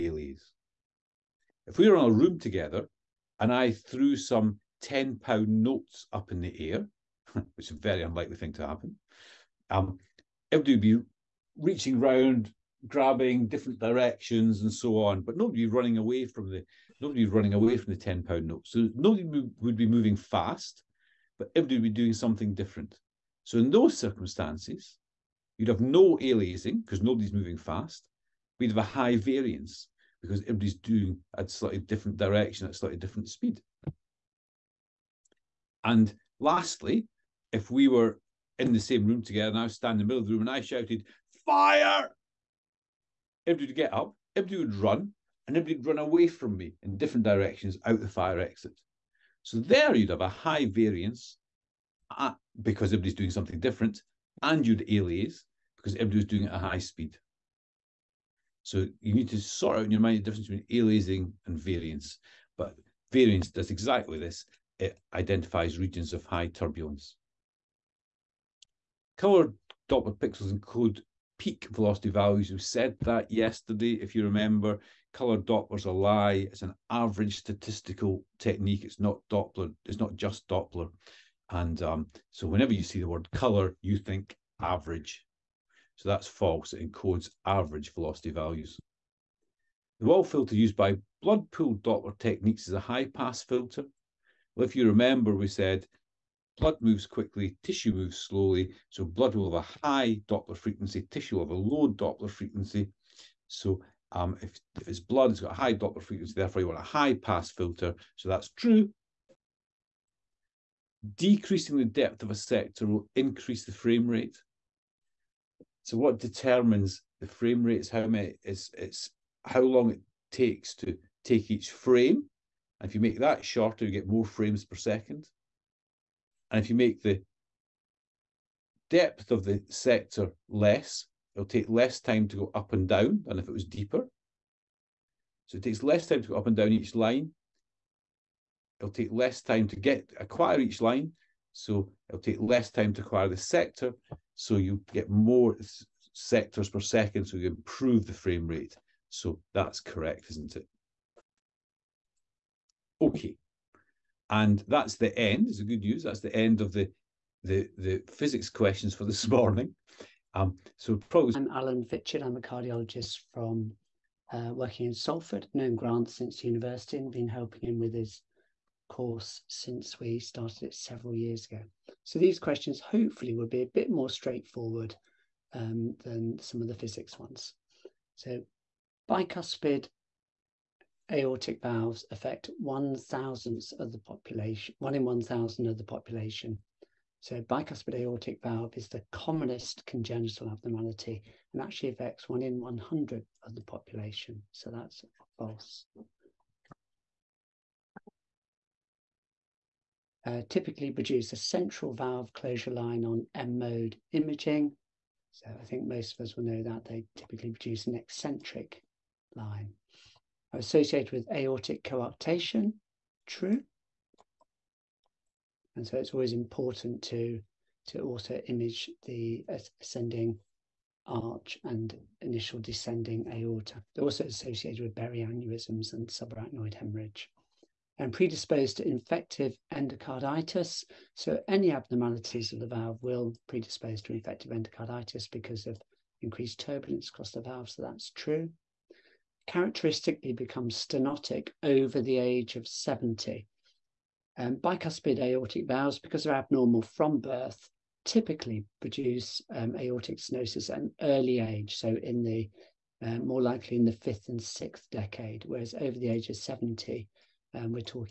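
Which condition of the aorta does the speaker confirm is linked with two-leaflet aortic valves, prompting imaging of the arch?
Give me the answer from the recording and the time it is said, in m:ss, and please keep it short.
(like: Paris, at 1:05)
Aortic coarctation, at 3:31.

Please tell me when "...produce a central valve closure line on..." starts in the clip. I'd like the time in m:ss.
3:20.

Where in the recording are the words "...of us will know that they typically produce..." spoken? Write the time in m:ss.
3:26.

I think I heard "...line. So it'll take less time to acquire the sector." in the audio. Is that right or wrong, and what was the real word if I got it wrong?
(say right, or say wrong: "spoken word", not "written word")
right.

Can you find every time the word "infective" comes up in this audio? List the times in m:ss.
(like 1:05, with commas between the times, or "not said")
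3:48, 3:54.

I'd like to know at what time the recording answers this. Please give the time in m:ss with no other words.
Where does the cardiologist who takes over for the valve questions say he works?
2:44.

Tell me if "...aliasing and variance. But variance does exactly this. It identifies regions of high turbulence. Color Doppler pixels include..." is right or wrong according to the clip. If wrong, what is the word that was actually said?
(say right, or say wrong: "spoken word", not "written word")
right.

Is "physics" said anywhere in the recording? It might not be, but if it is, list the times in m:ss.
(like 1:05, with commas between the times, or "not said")
2:38, 2:56.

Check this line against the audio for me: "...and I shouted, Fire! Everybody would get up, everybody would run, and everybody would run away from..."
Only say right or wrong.
right.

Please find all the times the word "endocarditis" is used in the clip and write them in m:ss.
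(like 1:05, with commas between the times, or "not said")
3:49, 3:54.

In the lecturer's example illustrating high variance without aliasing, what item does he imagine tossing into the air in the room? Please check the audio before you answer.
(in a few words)
10 pound notes.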